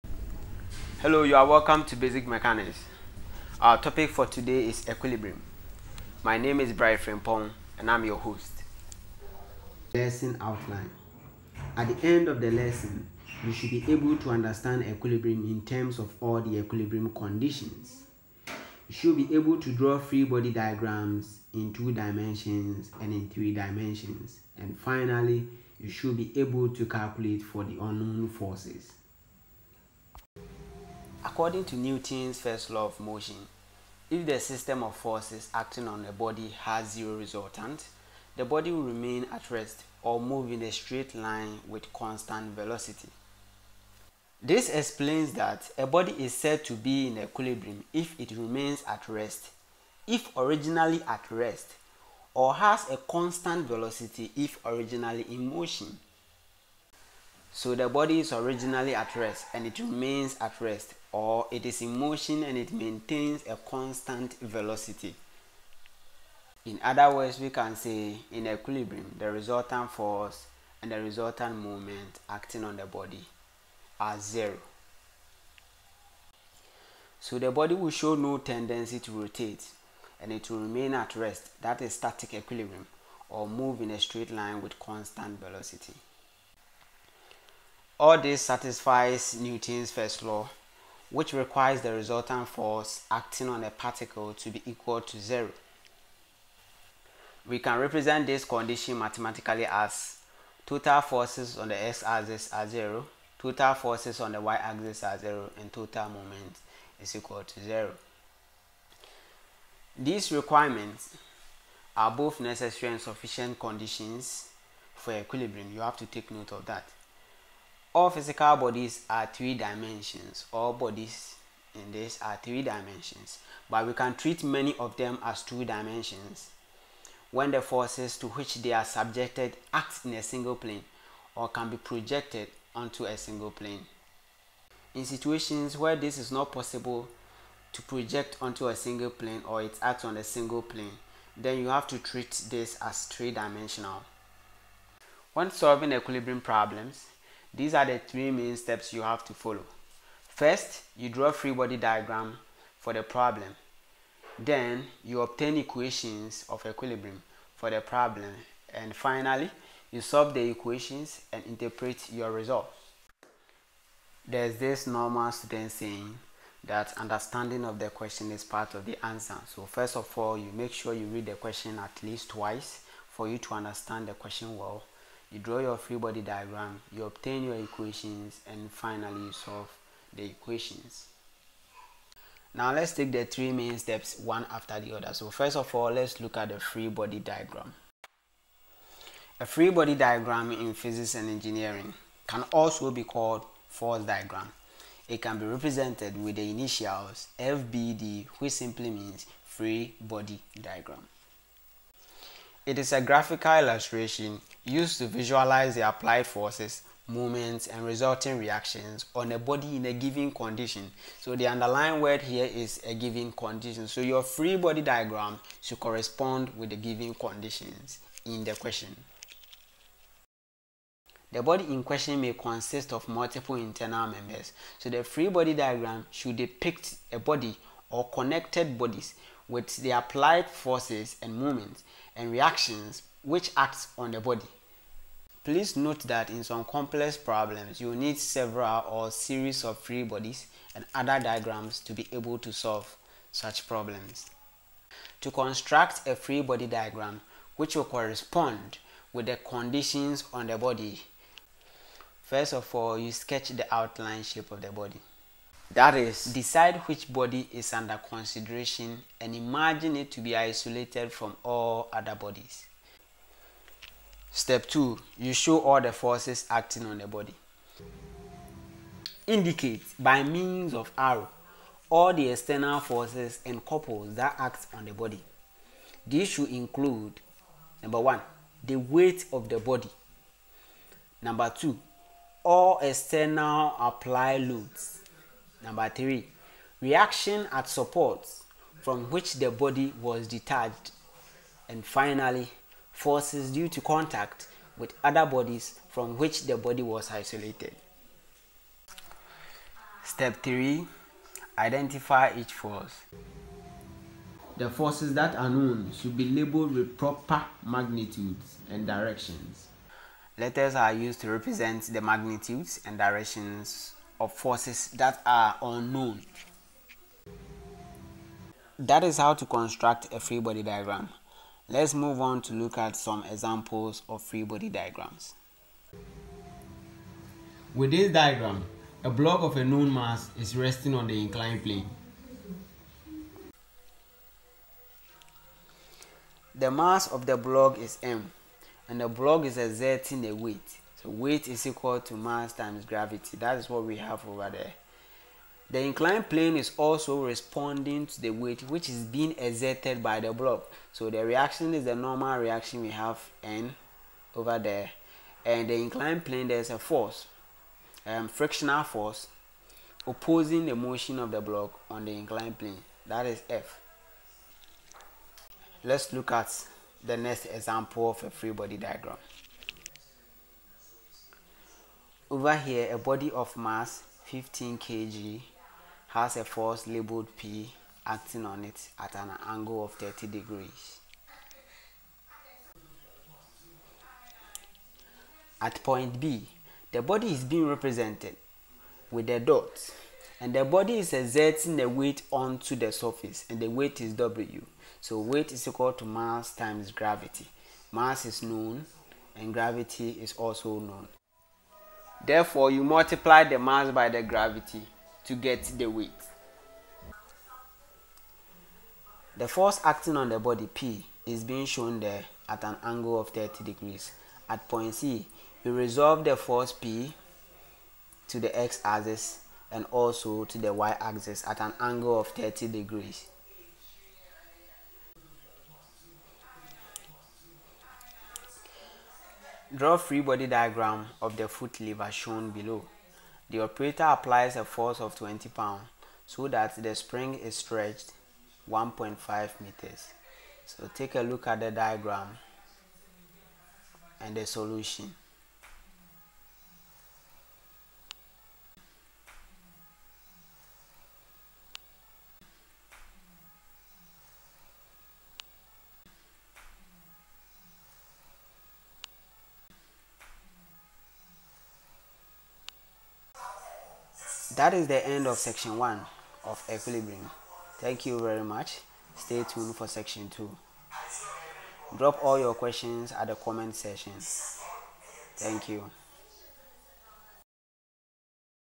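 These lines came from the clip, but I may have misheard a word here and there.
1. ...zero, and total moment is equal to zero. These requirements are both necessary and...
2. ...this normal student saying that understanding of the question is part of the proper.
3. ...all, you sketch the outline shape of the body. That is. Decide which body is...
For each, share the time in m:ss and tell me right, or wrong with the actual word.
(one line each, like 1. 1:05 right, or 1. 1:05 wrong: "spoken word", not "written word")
1. 1:45 right
2. 2:44 wrong: "answer", not "proper"
3. 4:12 right.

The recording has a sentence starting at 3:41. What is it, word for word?
The body in question may consist of multiple internal members.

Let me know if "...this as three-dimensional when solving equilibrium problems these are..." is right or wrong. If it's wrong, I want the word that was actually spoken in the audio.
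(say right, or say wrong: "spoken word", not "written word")
right.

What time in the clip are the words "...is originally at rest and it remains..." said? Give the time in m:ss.
0:58.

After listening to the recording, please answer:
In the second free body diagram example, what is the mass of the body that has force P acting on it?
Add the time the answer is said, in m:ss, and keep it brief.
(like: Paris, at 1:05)
15 kg, at 6:14.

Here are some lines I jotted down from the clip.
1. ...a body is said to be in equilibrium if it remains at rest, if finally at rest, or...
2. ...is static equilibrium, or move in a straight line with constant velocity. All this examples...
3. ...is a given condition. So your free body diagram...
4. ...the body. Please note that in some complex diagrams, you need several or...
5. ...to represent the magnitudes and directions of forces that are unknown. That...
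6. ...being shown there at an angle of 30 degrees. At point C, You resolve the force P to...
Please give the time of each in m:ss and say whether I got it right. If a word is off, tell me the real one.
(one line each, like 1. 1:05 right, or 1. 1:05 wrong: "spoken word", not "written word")
1. 0:45 wrong: "originally", not "finally"
2. 1:21 wrong: "satisfies", not "examples"
3. 3:32 right
4. 3:54 wrong: "problems", not "diagrams"
5. 5:11 right
6. 6:51 right.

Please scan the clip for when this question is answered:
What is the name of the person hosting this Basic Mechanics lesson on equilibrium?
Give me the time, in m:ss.
0:06.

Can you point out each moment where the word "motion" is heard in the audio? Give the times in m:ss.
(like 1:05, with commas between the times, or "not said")
0:32, 0:55, 1:01, 6:00.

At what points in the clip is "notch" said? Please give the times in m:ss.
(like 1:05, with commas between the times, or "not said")
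not said.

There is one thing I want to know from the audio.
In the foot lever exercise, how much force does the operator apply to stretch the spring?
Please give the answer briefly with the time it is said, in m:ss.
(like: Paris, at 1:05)
20 pounds, at 7:15.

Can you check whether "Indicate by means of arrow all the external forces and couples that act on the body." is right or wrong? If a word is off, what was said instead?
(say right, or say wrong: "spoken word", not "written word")
right.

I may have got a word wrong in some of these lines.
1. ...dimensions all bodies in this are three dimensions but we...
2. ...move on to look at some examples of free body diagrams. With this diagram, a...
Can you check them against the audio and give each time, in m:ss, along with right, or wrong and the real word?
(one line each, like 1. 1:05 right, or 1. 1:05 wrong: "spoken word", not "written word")
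1. 1:59 right
2. 5:21 right.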